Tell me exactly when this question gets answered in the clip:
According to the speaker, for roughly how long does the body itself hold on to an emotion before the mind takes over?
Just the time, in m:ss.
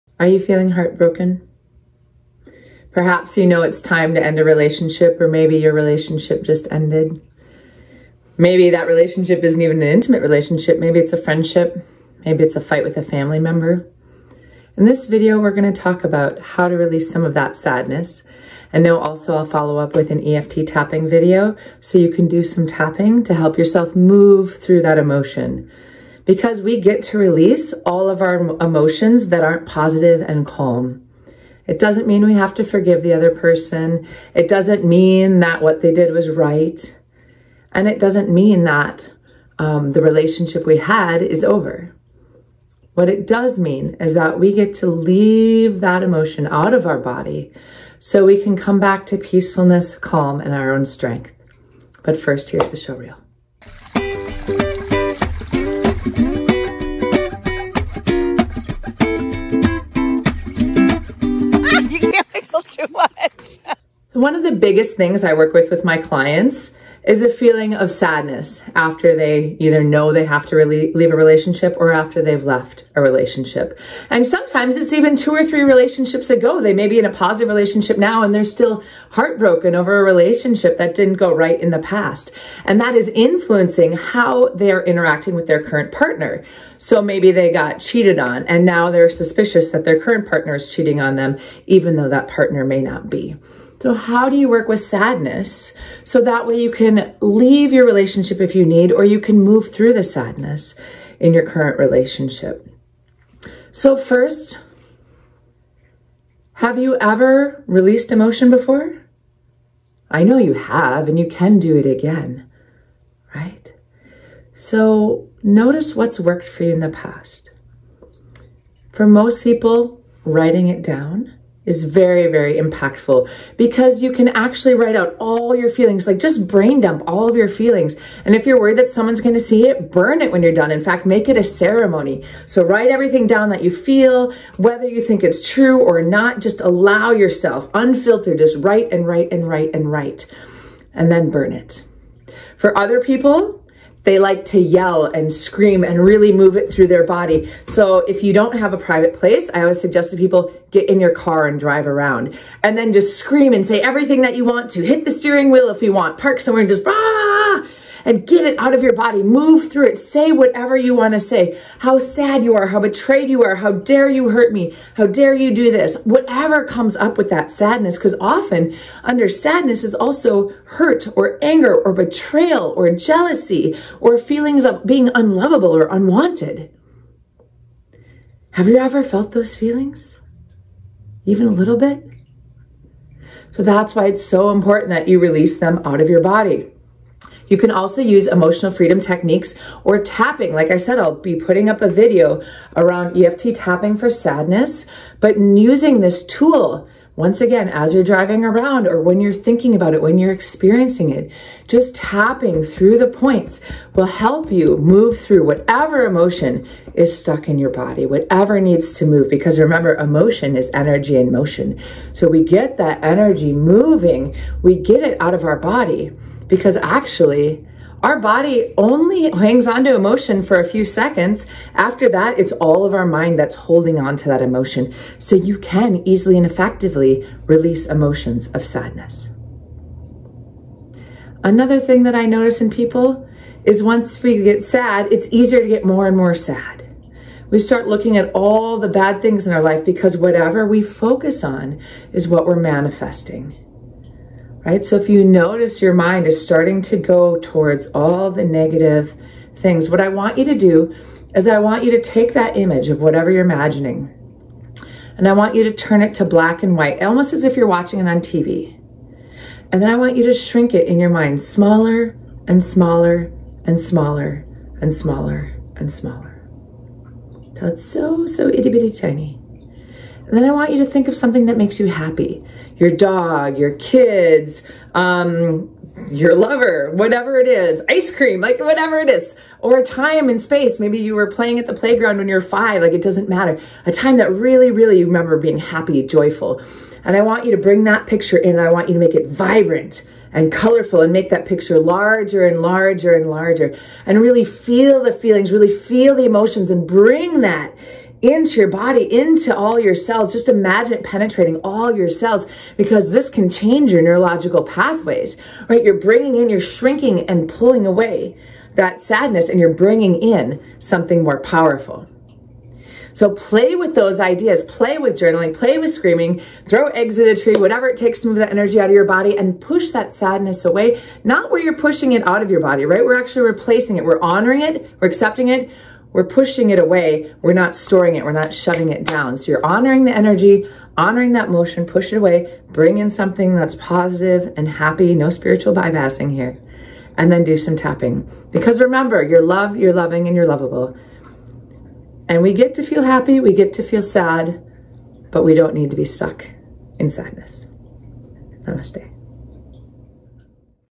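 3:40.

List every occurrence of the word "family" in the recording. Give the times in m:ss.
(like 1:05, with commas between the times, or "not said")
0:13.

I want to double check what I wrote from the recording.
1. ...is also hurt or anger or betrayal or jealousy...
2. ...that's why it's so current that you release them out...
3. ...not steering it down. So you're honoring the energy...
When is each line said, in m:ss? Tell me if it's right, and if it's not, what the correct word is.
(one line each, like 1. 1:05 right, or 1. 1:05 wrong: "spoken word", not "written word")
1. 2:49 right
2. 3:03 wrong: "important", not "current"
3. 5:28 wrong: "shutting", not "steering".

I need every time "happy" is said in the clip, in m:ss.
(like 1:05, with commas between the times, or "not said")
4:31, 4:45, 5:34, 5:43.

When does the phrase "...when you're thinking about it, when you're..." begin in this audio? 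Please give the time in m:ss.
3:18.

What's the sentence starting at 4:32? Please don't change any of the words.
Your dog, your kids, um, your lover, whatever it is, ice cream, like whatever it is, or a time and space.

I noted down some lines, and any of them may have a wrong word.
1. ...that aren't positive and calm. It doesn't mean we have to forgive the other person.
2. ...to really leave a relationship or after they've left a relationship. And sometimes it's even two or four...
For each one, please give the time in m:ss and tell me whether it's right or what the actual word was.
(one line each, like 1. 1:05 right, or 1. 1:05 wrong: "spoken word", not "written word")
1. 0:29 right
2. 1:10 wrong: "three", not "four".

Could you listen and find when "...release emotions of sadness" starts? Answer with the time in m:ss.
3:47.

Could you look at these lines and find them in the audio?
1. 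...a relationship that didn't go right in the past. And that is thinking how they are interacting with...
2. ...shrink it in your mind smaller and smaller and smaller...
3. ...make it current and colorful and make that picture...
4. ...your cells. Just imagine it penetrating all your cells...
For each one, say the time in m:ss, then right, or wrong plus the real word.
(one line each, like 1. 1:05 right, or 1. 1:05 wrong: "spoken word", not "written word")
1. 1:19 wrong: "influencing", not "thinking"
2. 4:20 right
3. 4:49 wrong: "vibrant", not "current"
4. 4:59 right.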